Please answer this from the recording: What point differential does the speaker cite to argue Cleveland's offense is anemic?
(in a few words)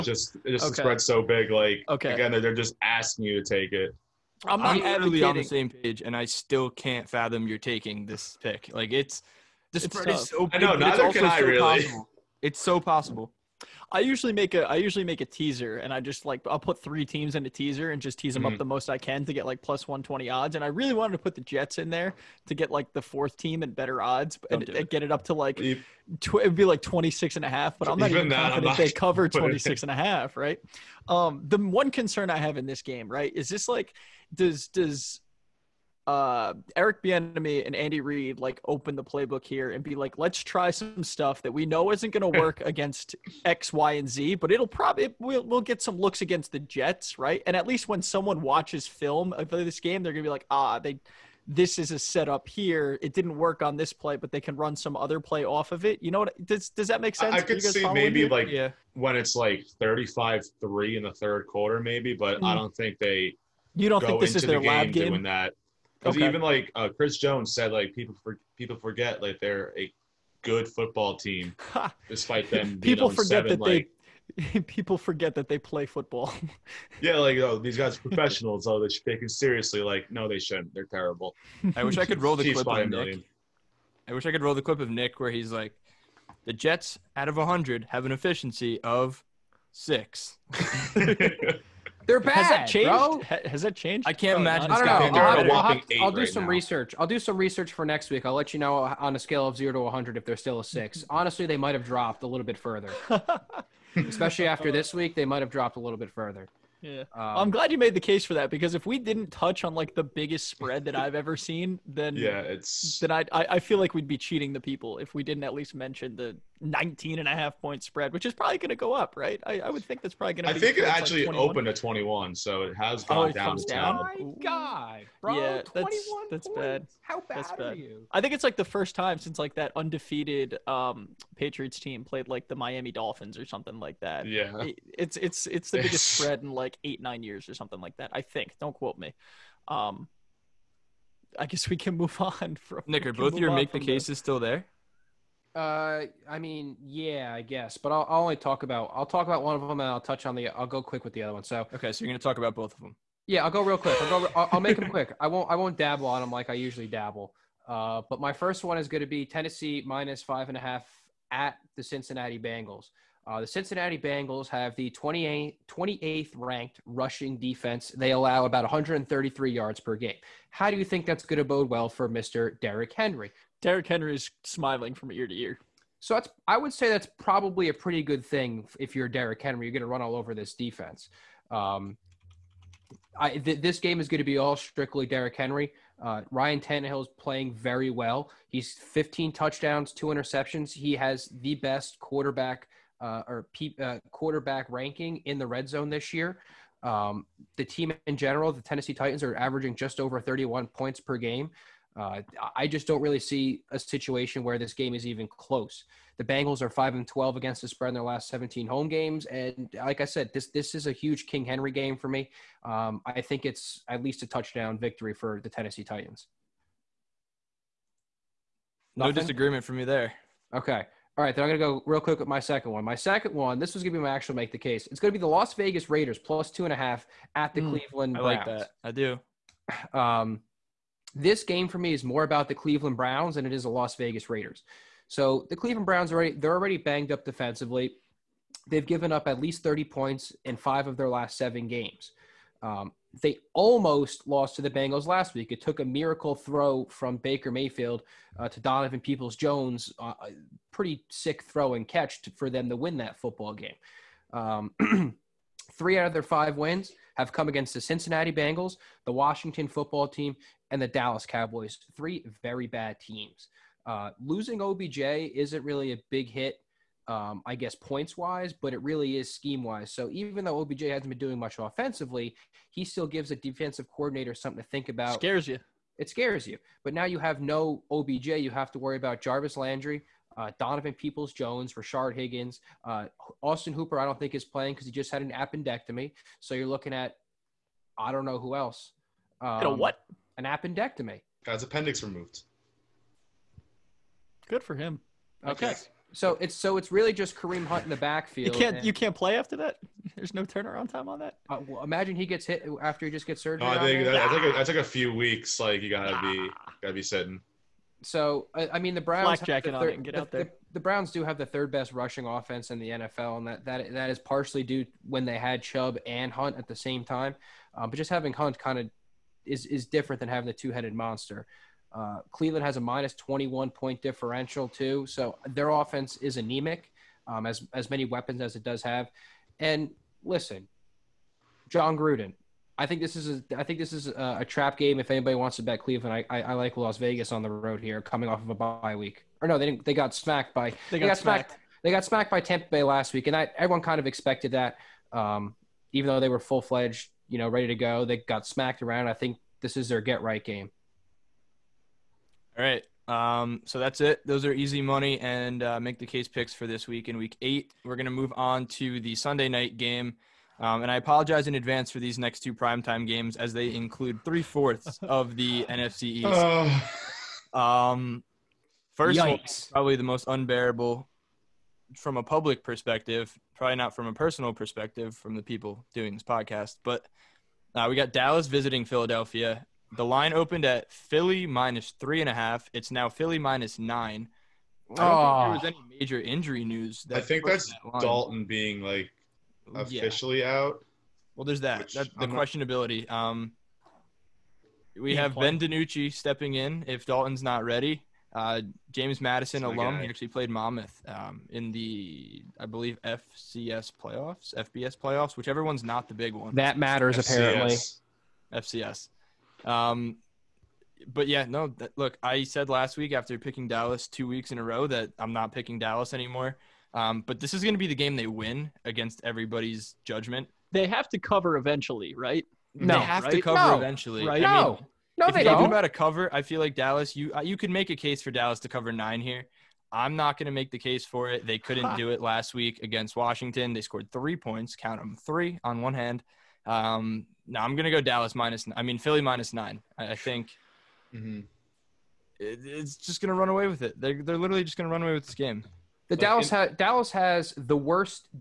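-21.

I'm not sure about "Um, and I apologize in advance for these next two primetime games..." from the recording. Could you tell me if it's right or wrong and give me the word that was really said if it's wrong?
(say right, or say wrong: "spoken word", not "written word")
right.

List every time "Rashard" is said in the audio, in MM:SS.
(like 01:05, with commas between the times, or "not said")
04:41.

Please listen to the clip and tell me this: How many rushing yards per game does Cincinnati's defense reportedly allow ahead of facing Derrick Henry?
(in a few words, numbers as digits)
133.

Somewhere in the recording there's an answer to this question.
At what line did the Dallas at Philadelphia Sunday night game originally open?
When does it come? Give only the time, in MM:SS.
06:20.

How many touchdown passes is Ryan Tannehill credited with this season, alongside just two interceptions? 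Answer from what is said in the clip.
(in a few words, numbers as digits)
15.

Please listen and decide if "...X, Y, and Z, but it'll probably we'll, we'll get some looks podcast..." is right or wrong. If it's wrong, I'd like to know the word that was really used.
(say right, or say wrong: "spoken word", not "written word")
wrong: "against", not "podcast".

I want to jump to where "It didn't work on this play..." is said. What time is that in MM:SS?
00:53.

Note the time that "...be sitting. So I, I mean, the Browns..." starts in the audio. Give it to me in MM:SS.
05:06.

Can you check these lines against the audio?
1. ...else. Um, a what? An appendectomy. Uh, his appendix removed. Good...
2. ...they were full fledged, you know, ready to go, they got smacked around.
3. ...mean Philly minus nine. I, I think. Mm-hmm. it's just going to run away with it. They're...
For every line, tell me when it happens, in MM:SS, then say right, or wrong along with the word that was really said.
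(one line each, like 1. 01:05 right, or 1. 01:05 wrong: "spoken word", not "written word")
1. 04:48 right
2. 05:46 right
3. 07:18 right.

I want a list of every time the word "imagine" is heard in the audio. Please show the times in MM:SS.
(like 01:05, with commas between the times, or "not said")
01:34, 05:01.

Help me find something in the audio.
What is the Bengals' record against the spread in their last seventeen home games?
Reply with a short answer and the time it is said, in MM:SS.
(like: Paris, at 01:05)
5-12, at 03:26.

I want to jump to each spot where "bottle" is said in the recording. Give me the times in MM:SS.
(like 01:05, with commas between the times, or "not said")
not said.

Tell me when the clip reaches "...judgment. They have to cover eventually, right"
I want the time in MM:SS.
07:00.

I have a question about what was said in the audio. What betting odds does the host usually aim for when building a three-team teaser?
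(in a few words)
+120.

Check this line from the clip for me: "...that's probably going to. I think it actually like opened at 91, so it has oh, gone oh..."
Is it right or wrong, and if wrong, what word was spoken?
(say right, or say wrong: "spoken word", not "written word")
wrong: "21", not "91".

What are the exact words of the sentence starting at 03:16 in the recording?
Um, the team in general, the Tennessee Titans are averaging just over 31 points per game.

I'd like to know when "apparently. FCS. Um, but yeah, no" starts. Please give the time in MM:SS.
06:47.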